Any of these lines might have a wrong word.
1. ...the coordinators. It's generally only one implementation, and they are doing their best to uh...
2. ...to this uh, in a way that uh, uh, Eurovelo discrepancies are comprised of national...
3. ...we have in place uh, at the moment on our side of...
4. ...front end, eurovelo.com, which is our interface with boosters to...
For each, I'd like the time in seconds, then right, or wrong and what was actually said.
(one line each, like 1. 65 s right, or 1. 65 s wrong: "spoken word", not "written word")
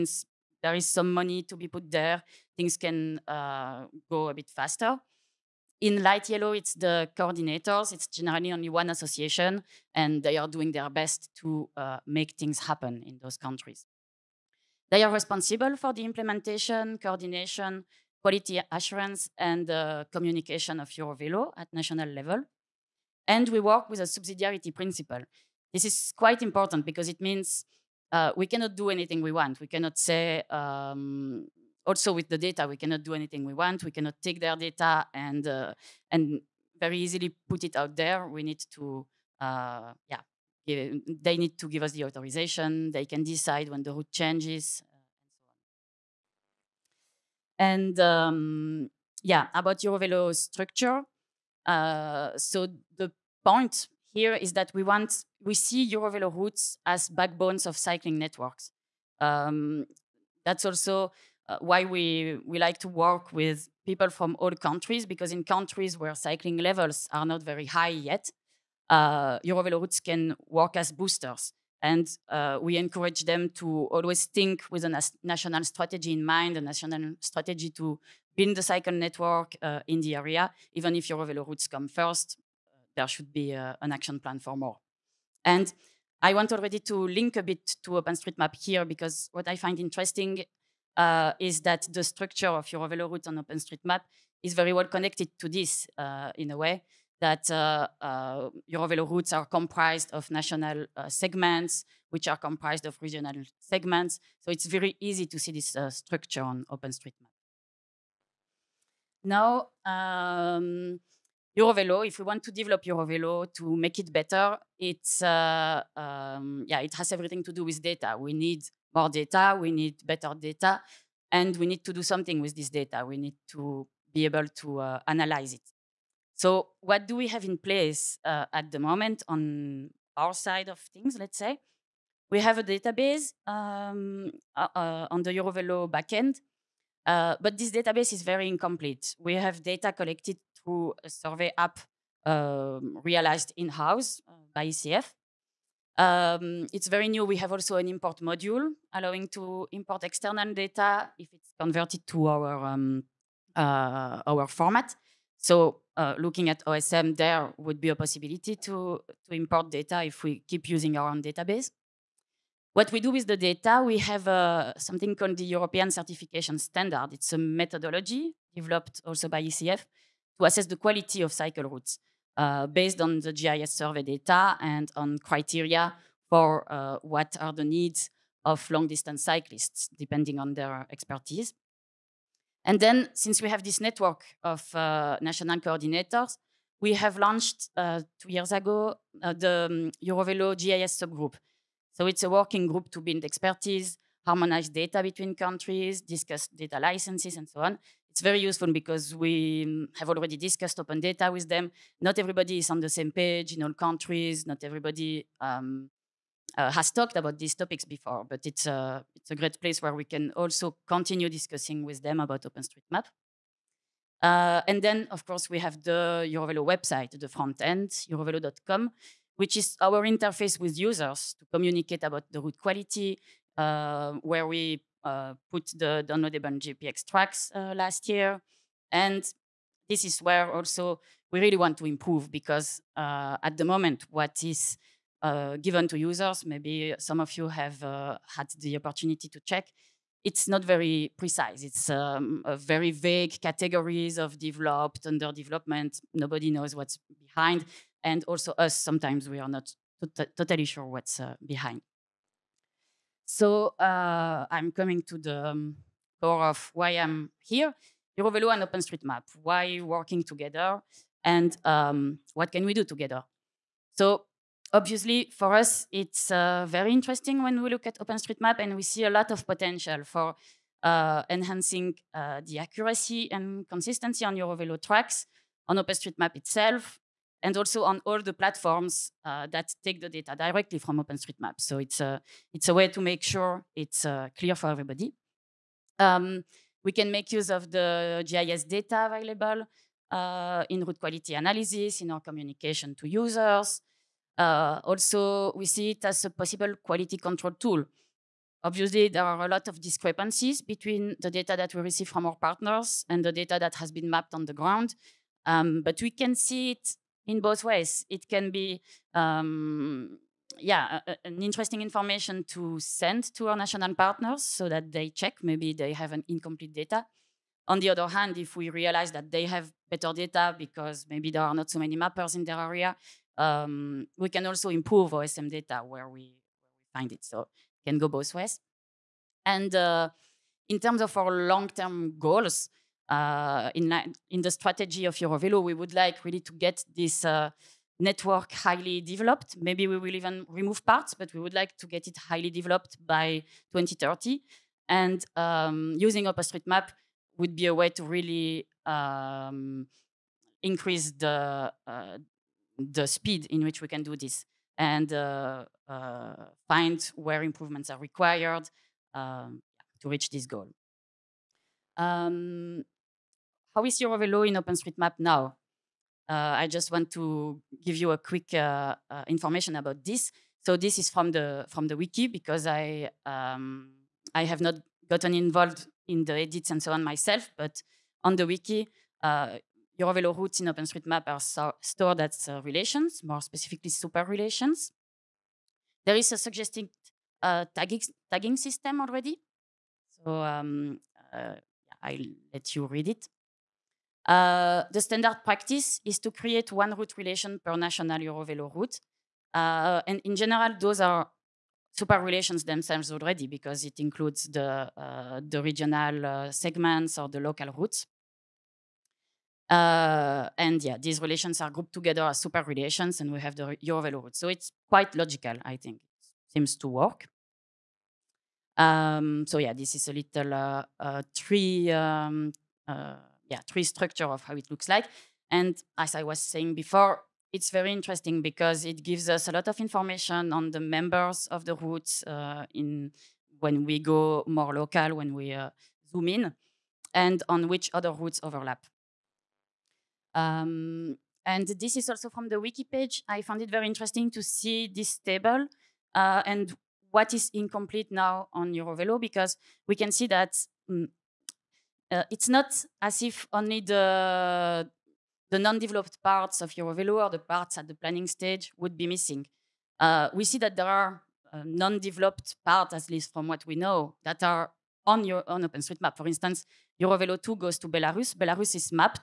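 1. 6 s wrong: "association", not "implementation"
2. 95 s wrong: "routes", not "discrepancies"
3. 127 s right
4. 217 s wrong: "users", not "boosters".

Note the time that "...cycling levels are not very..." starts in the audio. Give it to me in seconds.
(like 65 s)
66 s.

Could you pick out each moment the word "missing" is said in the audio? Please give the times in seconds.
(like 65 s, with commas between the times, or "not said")
459 s.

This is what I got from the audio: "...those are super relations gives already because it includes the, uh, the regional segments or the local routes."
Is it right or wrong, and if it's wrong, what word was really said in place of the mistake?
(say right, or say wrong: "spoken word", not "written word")
wrong: "themselves", not "gives".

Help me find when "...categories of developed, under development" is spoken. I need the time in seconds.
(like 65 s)
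243 s.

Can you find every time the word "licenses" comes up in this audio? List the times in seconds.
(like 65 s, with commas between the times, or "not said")
196 s.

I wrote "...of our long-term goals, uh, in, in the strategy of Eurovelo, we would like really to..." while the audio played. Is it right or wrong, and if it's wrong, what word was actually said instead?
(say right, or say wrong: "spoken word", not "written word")
right.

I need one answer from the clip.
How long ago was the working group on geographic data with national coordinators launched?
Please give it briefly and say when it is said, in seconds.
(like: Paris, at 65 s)
2 years ago, at 188 s.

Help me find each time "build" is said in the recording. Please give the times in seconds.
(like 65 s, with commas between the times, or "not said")
78 s, 192 s.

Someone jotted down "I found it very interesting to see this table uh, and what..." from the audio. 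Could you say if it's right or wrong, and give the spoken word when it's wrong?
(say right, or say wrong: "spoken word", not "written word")
right.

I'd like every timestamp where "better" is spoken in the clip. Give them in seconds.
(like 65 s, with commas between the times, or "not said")
114 s, 120 s, 319 s.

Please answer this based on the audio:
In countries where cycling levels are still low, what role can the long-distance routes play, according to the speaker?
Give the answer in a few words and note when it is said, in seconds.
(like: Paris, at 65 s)
boosters, at 70 s.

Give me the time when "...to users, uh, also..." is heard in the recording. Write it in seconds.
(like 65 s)
292 s.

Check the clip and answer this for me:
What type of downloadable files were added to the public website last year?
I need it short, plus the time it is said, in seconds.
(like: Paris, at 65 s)
GPX tracks, at 226 s.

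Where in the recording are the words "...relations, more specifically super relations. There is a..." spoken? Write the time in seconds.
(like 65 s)
382 s.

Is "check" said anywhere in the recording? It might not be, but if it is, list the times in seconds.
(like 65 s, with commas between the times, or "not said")
239 s, 315 s.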